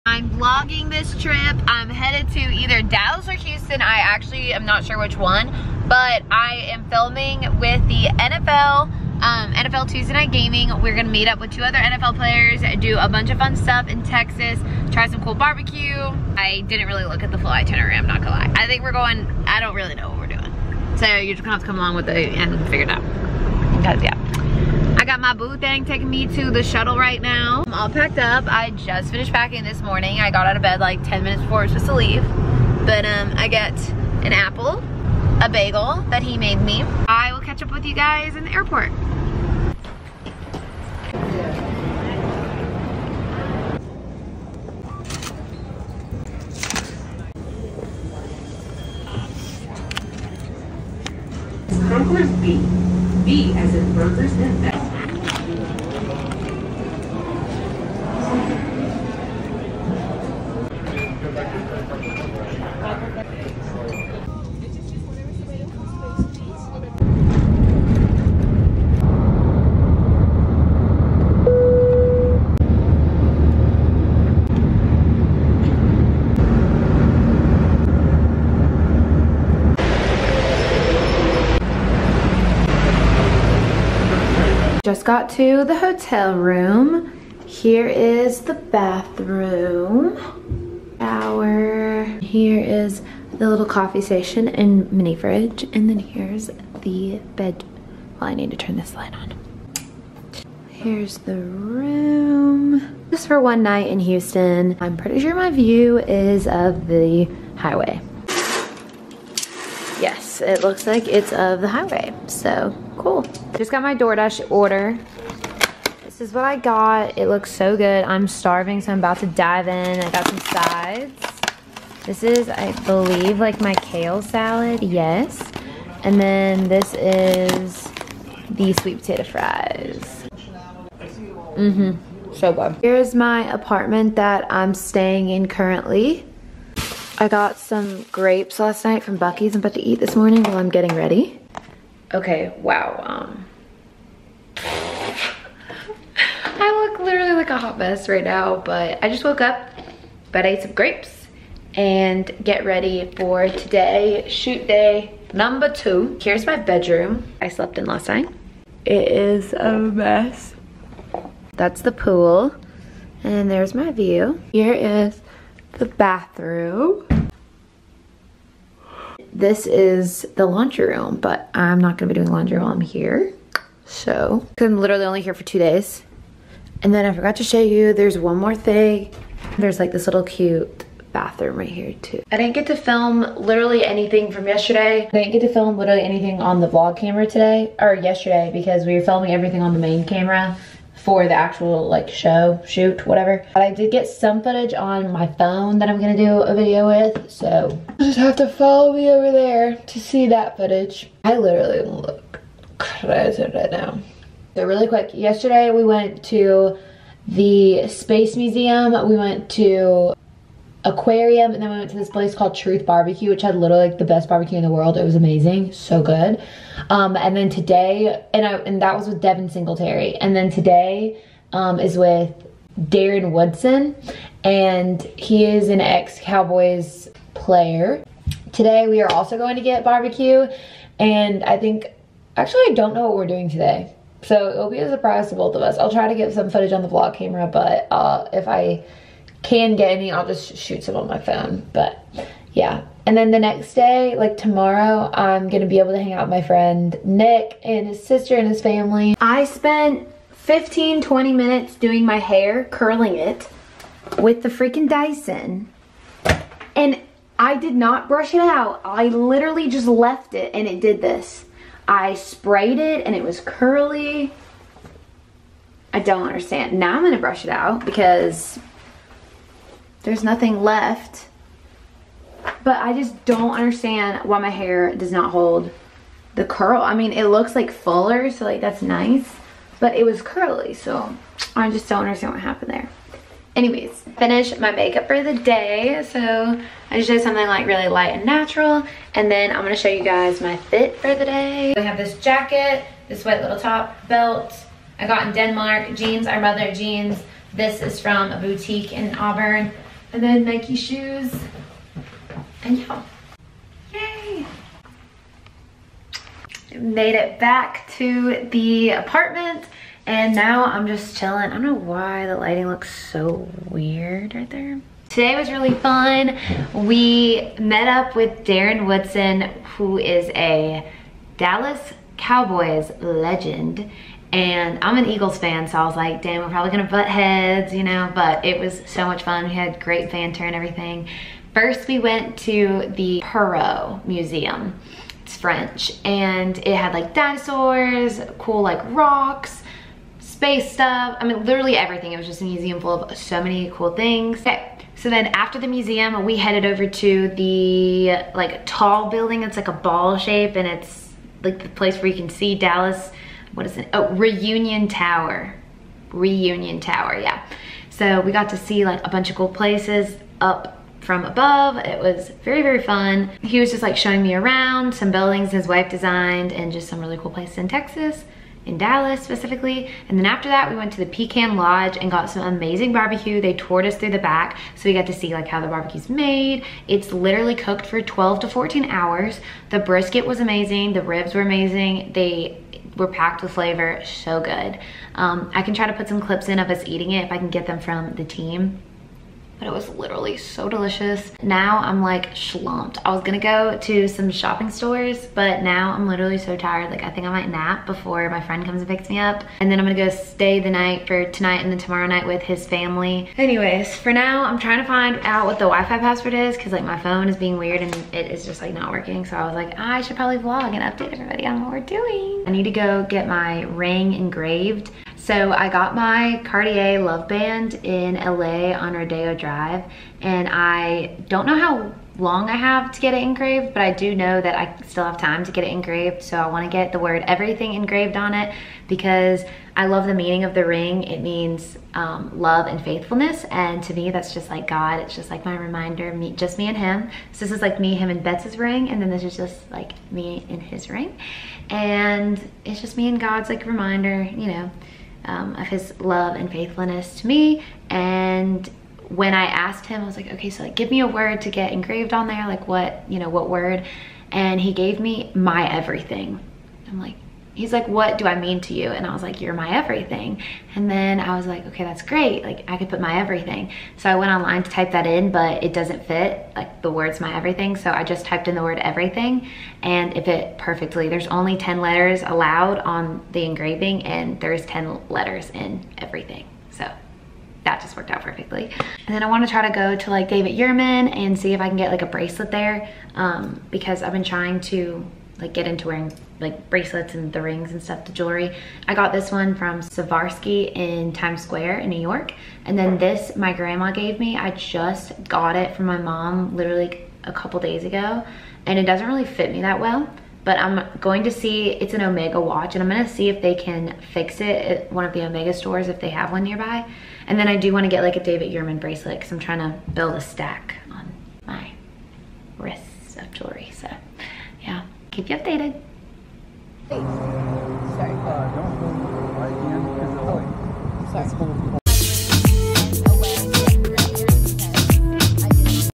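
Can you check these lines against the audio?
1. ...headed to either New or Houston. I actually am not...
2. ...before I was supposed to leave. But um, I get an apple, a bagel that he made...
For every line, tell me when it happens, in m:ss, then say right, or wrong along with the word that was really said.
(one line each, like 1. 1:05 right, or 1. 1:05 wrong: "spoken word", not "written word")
1. 0:01 wrong: "Dallas", not "New"
2. 0:31 right.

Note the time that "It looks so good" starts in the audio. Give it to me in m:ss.
1:57.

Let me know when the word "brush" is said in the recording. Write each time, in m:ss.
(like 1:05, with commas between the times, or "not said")
4:18, 4:27.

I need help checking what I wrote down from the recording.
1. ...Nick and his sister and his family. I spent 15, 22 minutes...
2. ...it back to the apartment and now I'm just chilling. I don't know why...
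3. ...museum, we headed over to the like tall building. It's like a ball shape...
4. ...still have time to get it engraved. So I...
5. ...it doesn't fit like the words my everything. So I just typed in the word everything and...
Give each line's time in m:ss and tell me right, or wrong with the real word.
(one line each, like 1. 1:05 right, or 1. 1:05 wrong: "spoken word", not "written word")
1. 4:07 wrong: "20", not "22"
2. 5:07 right
3. 5:45 right
4. 7:04 right
5. 7:45 right.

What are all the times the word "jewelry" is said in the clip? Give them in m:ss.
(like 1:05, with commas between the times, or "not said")
8:08, 8:33.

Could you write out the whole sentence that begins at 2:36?
Here's my bedroom I slept in last night.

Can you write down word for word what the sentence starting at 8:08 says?
I got this one from Swarovski in Times Square in New York.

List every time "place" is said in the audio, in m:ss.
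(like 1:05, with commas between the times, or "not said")
3:32, 5:51, 5:59, 6:07.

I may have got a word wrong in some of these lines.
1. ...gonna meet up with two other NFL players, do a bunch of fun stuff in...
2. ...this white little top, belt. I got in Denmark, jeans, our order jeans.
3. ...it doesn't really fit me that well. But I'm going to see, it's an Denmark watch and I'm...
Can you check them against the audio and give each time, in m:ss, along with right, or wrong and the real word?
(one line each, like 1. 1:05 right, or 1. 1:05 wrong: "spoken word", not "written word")
1. 0:10 right
2. 4:53 wrong: "mother", not "order"
3. 8:18 wrong: "Omega", not "Denmark".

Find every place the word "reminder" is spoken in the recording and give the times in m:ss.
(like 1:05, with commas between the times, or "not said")
7:15, 7:23.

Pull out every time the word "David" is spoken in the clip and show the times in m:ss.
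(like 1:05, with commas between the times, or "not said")
8:00, 8:28.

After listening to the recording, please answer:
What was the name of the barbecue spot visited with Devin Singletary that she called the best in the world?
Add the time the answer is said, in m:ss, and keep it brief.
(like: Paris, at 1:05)
Truth Barbecue, at 3:32.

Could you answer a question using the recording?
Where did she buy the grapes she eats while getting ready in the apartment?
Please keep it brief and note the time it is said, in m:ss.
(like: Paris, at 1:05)
Buc-ee's, at 2:19.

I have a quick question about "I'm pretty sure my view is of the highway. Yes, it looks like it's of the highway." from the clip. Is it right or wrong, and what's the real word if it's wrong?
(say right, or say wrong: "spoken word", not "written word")
right.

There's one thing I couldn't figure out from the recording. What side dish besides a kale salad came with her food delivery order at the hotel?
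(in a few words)
Sweet potato fries.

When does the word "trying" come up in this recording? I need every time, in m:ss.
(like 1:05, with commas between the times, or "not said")
6:44, 8:04, 8:29.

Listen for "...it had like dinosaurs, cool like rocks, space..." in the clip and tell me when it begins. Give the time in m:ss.
5:36.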